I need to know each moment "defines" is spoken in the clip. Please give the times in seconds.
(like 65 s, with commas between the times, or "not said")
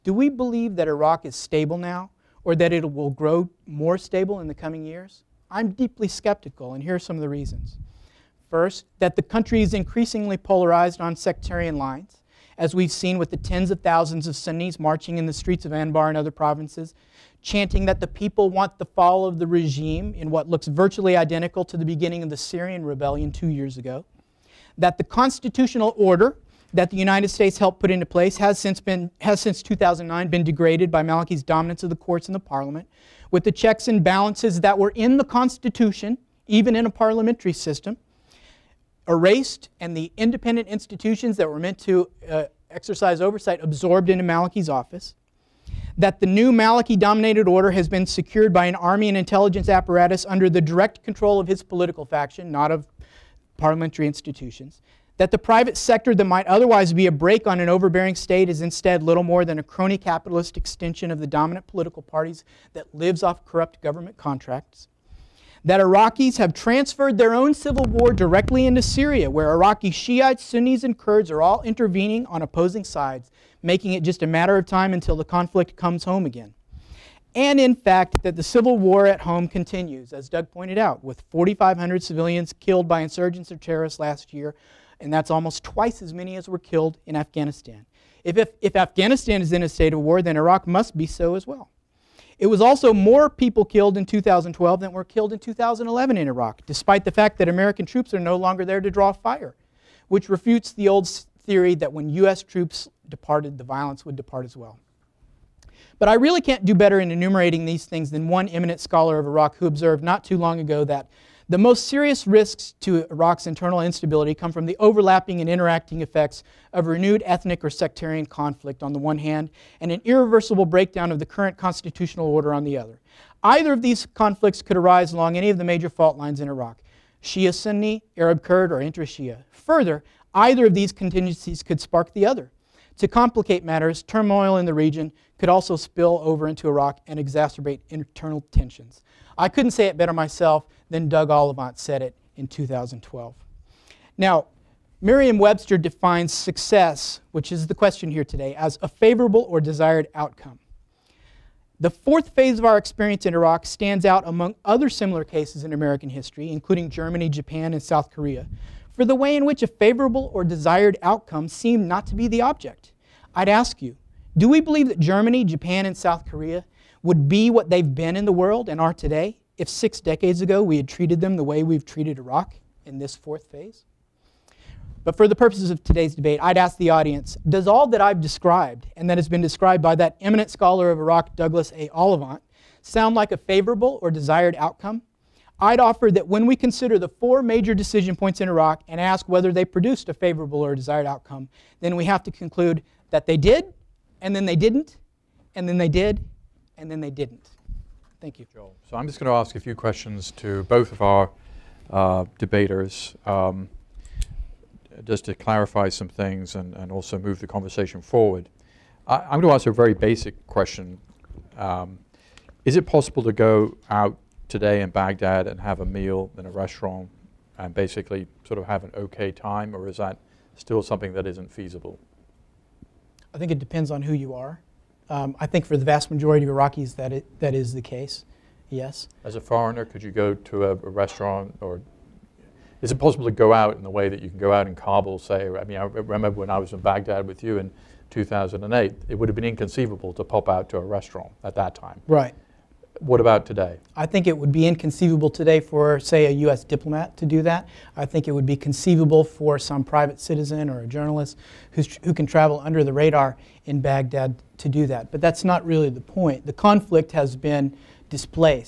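145 s.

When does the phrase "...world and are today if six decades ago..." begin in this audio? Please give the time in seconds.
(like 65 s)
168 s.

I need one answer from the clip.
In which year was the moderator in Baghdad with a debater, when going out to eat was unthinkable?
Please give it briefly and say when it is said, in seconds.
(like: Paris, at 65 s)
2008, at 238 s.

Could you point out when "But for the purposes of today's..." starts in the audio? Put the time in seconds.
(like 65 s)
175 s.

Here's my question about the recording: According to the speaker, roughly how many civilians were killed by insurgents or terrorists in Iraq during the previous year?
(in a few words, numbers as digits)
4,500.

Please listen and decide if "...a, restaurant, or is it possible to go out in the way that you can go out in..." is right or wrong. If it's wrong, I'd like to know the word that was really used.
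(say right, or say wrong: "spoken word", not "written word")
right.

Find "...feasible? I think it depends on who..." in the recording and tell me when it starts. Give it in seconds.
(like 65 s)
221 s.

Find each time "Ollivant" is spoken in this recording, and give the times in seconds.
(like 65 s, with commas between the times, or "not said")
141 s, 181 s.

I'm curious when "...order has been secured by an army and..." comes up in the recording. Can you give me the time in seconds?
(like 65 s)
47 s.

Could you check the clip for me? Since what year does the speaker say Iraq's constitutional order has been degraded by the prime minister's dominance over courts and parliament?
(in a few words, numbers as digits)
2009.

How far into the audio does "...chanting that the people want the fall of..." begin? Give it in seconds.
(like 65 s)
17 s.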